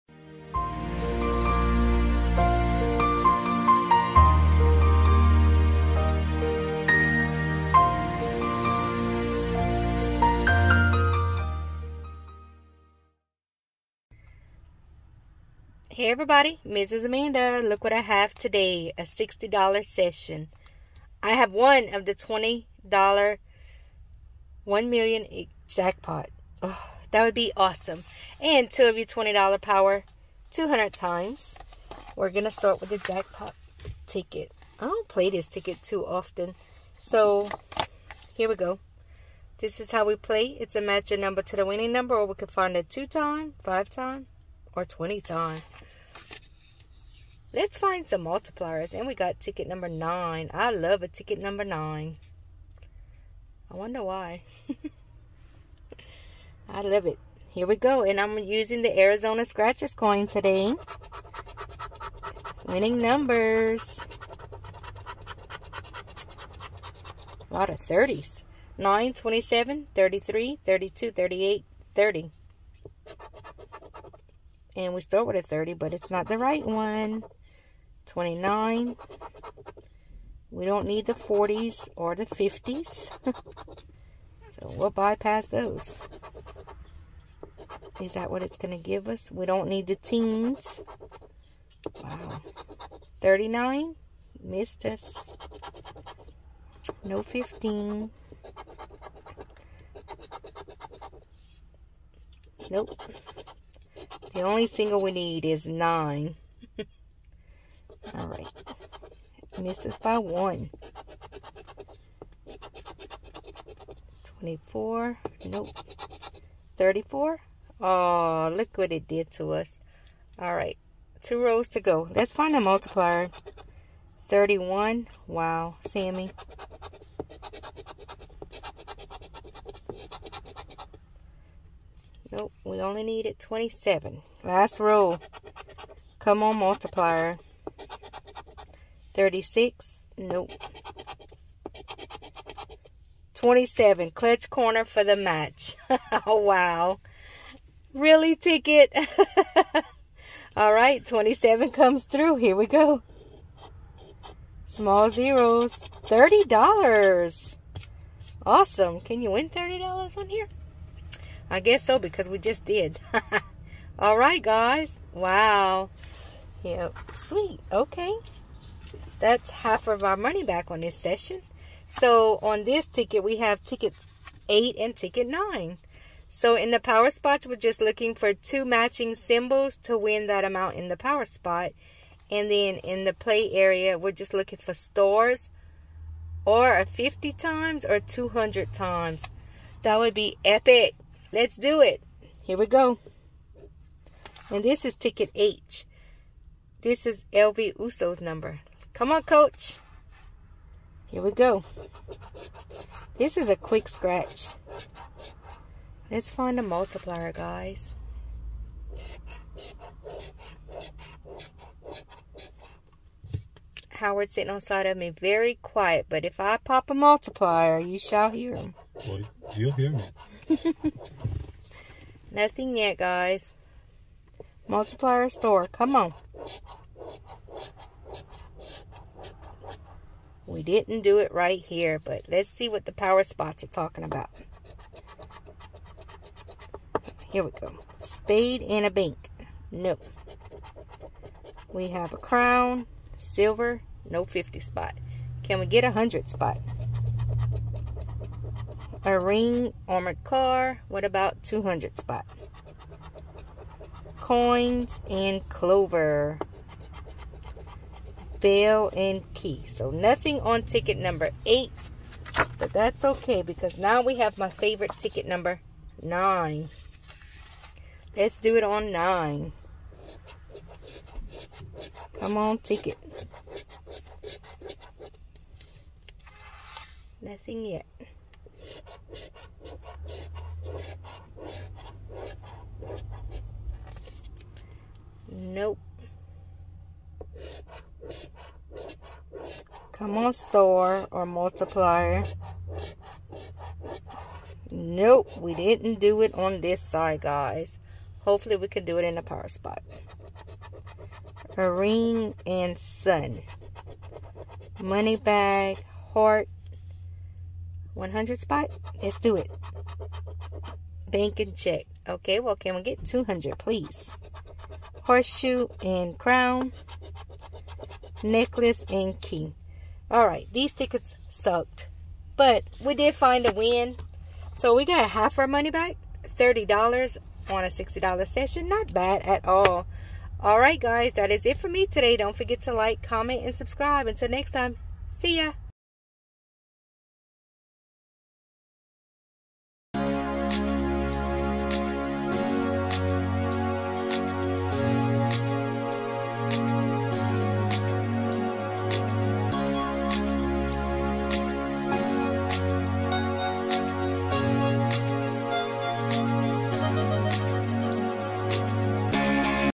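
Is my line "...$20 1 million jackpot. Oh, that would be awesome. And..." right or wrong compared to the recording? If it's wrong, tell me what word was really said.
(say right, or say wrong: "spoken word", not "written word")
right.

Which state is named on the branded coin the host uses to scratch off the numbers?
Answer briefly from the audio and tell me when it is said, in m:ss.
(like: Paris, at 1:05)
Arizona, at 0:58.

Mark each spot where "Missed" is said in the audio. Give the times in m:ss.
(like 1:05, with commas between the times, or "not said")
1:34, 1:49.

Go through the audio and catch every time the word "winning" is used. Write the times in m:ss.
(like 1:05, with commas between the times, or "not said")
0:41, 1:02.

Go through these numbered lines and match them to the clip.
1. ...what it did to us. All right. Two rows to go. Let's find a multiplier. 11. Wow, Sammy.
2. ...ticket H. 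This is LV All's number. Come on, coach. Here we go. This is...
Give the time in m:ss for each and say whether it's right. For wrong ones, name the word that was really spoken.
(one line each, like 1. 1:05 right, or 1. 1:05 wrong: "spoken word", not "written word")
1. 1:58 wrong: "31", not "11"
2. 3:14 wrong: "Uso", not "All".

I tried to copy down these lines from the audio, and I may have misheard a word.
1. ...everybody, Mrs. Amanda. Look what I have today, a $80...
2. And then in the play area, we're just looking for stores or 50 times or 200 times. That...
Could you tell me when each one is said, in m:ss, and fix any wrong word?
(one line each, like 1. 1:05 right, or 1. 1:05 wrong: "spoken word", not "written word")
1. 0:16 wrong: "60", not "80"
2. 3:02 right.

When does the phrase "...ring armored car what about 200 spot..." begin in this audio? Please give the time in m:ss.
4:09.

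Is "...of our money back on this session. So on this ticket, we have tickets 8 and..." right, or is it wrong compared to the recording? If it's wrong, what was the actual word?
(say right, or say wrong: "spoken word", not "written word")
right.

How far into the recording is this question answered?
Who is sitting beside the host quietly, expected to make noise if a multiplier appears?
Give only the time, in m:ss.
3:33.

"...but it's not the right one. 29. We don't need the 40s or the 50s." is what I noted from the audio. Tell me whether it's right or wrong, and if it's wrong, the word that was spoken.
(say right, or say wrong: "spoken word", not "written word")
right.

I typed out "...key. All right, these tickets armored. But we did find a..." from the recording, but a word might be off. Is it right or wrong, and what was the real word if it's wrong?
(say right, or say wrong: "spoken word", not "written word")
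wrong: "sucked", not "armored".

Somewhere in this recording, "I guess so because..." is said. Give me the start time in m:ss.
2:41.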